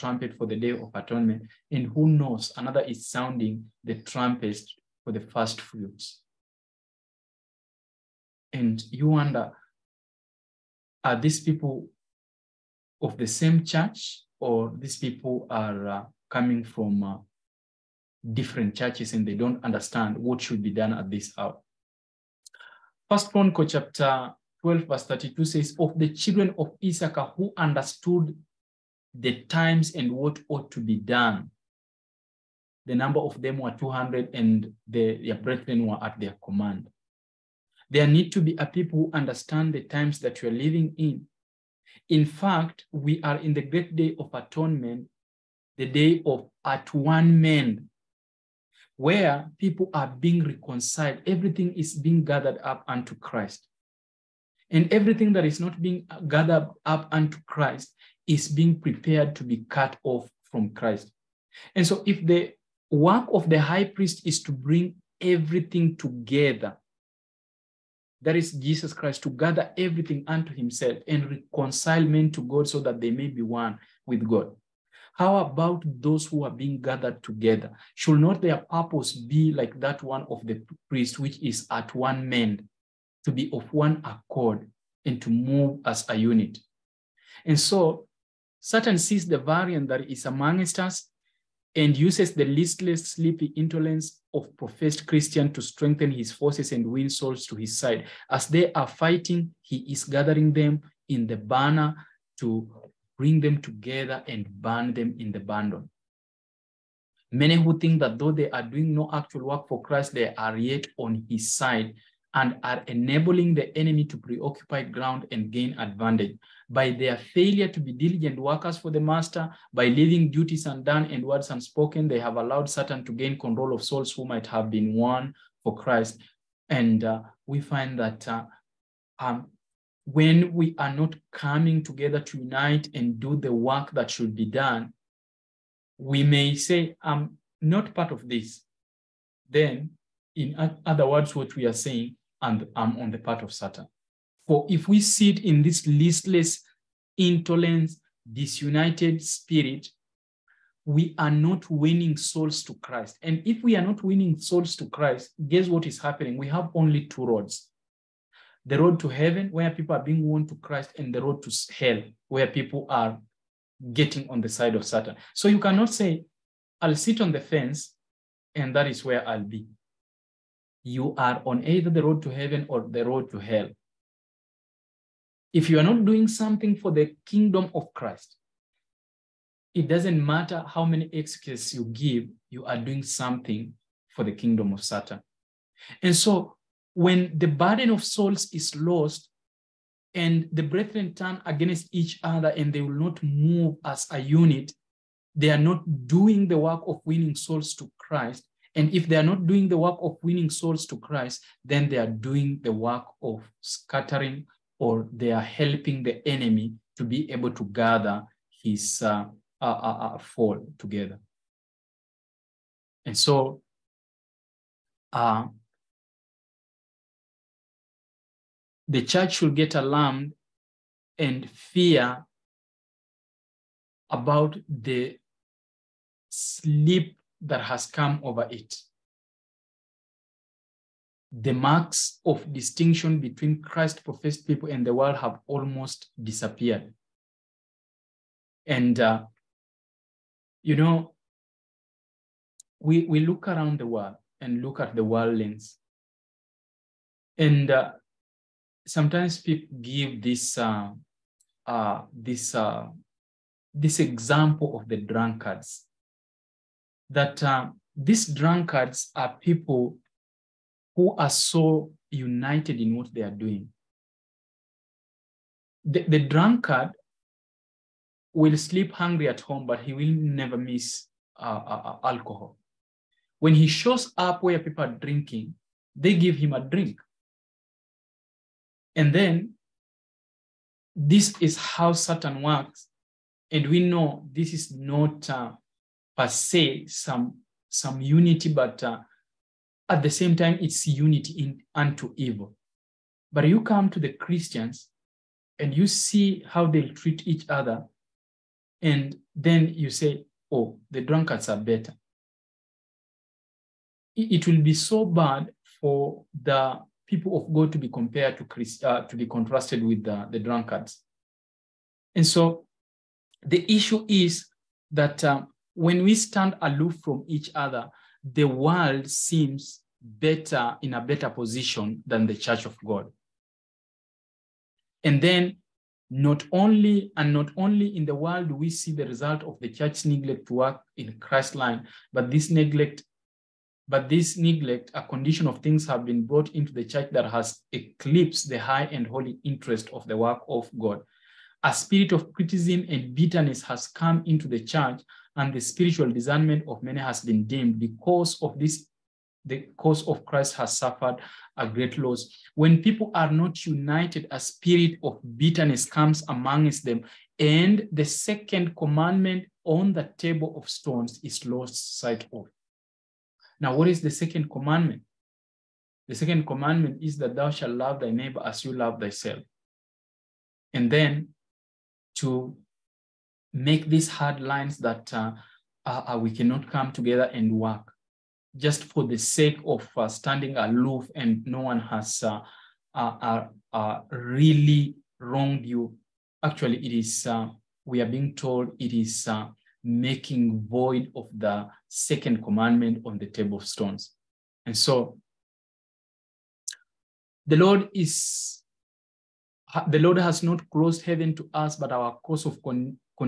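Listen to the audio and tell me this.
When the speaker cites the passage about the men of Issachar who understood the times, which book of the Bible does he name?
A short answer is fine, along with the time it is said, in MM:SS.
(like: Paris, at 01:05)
First Chronicles, at 00:23.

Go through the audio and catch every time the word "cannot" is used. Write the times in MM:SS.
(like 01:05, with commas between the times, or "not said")
02:45, 06:16.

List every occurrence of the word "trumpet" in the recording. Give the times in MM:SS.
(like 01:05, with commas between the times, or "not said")
00:03.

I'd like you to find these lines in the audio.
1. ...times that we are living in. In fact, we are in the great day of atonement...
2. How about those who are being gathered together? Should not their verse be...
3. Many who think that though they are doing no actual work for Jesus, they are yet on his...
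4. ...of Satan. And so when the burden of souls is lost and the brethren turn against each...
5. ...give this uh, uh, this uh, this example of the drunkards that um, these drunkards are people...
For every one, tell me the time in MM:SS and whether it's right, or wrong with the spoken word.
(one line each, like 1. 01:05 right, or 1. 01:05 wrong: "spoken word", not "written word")
1. 00:39 right
2. 01:15 wrong: "purpose", not "verse"
3. 01:47 wrong: "Christ", not "Jesus"
4. 03:04 right
5. 04:09 right.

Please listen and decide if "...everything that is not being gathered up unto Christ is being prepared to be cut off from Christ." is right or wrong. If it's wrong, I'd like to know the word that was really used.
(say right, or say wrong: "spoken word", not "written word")
right.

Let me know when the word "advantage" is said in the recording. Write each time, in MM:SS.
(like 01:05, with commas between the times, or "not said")
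01:55.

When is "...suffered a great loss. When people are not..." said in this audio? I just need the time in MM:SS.
05:50.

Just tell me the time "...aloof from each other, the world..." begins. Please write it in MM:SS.
05:16.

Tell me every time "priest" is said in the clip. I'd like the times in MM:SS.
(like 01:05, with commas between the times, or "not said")
01:03, 01:20.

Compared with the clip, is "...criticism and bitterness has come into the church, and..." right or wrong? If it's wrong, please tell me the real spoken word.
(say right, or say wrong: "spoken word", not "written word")
right.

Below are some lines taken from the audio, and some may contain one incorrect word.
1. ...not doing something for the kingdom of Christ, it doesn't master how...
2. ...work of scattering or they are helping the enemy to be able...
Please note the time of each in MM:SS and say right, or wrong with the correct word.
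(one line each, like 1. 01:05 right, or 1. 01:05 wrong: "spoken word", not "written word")
1. 02:55 wrong: "matter", not "master"
2. 03:22 right.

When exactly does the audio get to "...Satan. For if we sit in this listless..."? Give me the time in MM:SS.
02:23.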